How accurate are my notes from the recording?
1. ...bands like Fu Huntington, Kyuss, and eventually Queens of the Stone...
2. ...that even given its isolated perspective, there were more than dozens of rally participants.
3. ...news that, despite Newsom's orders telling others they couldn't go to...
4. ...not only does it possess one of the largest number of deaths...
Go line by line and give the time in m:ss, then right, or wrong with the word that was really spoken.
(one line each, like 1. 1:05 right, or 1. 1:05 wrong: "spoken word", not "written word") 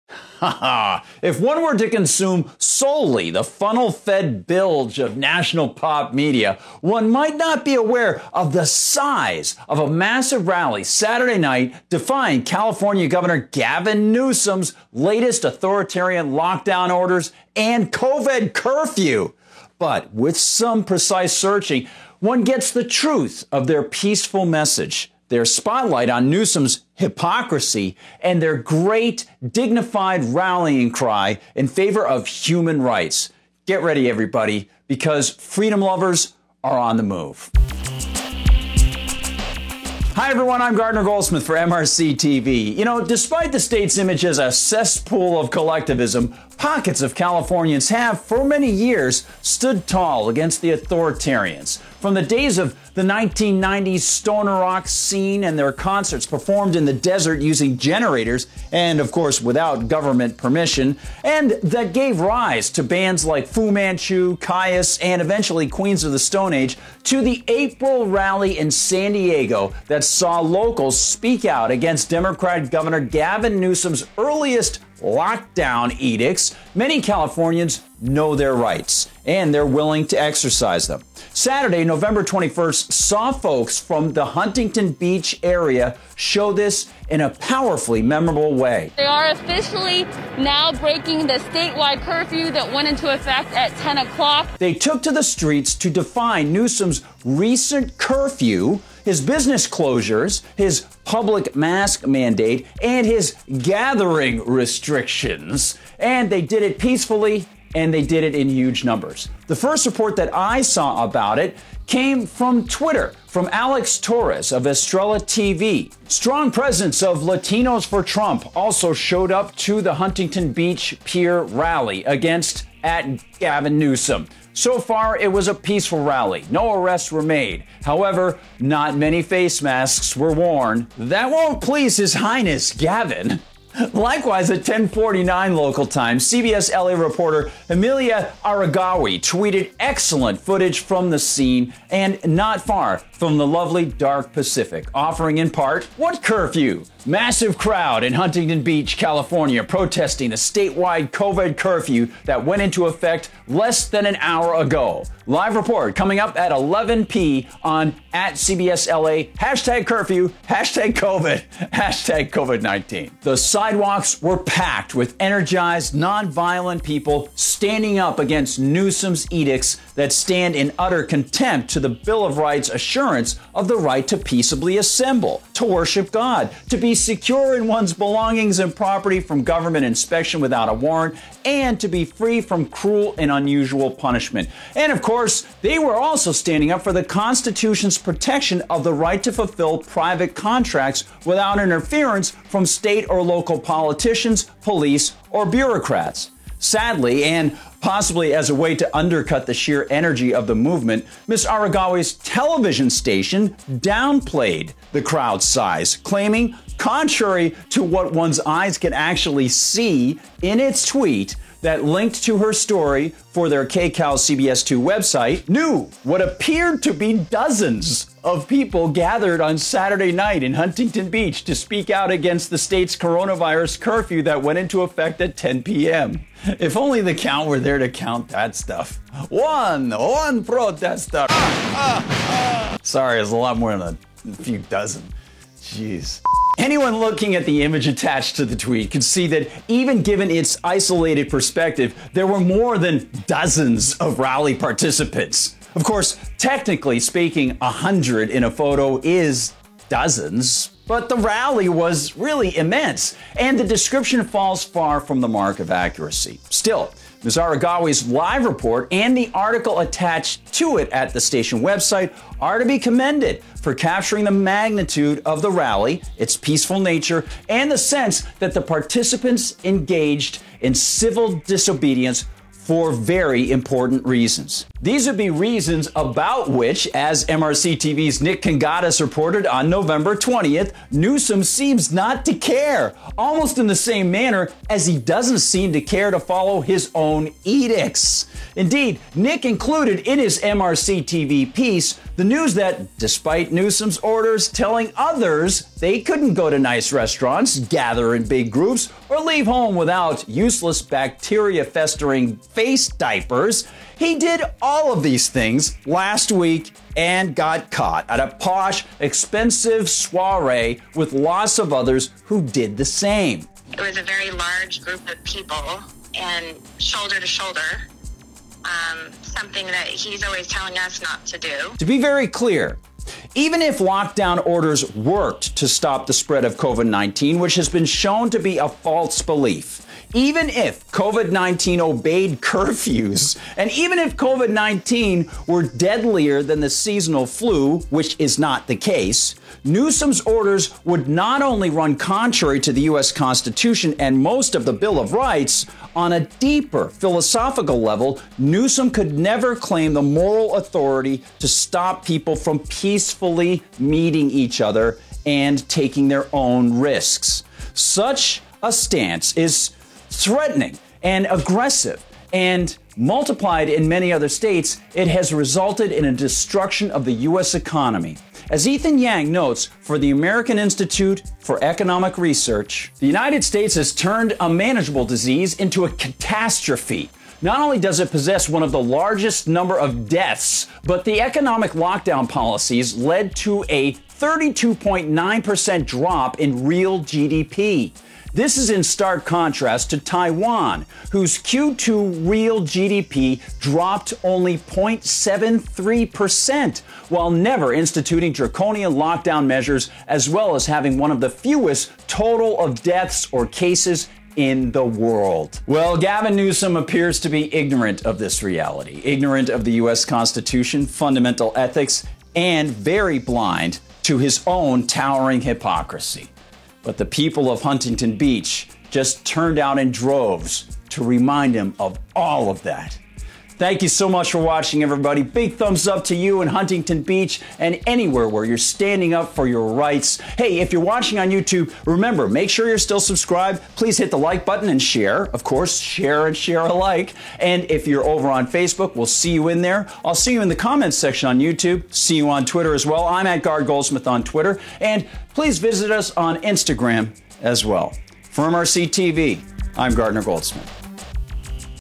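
1. 1:02 wrong: "Manchu", not "Huntington"
2. 3:59 right
3. 4:52 right
4. 6:17 right.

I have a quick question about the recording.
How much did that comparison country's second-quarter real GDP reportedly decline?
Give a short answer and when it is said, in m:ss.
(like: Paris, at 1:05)
0.73%, at 6:34.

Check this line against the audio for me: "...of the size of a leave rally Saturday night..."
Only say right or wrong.
wrong.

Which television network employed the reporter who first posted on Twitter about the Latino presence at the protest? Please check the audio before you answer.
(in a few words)
Estrella TV.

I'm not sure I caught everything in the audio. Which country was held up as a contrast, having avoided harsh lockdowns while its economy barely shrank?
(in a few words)
Taiwan.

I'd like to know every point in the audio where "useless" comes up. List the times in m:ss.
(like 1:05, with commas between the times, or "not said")
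5:00.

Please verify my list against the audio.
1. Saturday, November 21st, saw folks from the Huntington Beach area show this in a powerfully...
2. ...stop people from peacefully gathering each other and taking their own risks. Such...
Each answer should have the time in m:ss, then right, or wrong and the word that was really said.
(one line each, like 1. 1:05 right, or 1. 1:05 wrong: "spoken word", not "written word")
1. 1:21 right
2. 5:51 wrong: "meeting", not "gathering".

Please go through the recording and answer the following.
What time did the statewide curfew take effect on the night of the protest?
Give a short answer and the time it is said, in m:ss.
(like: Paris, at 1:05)
10 o'clock, at 1:33.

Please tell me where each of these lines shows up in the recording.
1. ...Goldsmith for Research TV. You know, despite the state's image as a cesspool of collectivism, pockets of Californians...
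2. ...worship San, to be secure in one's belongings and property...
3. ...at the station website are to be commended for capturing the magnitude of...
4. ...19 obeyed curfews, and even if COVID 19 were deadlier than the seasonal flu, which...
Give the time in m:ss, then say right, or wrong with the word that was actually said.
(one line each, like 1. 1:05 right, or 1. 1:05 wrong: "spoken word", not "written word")
1. 0:41 wrong: "MRC", not "Research"
2. 2:55 wrong: "God", not "San"
3. 4:20 right
4. 5:31 right.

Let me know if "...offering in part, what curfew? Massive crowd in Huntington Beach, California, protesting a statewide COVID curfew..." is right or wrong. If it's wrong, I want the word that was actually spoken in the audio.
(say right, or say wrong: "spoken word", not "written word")
right.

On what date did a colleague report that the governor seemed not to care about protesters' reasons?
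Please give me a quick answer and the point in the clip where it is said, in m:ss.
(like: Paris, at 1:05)
November 20th, at 4:39.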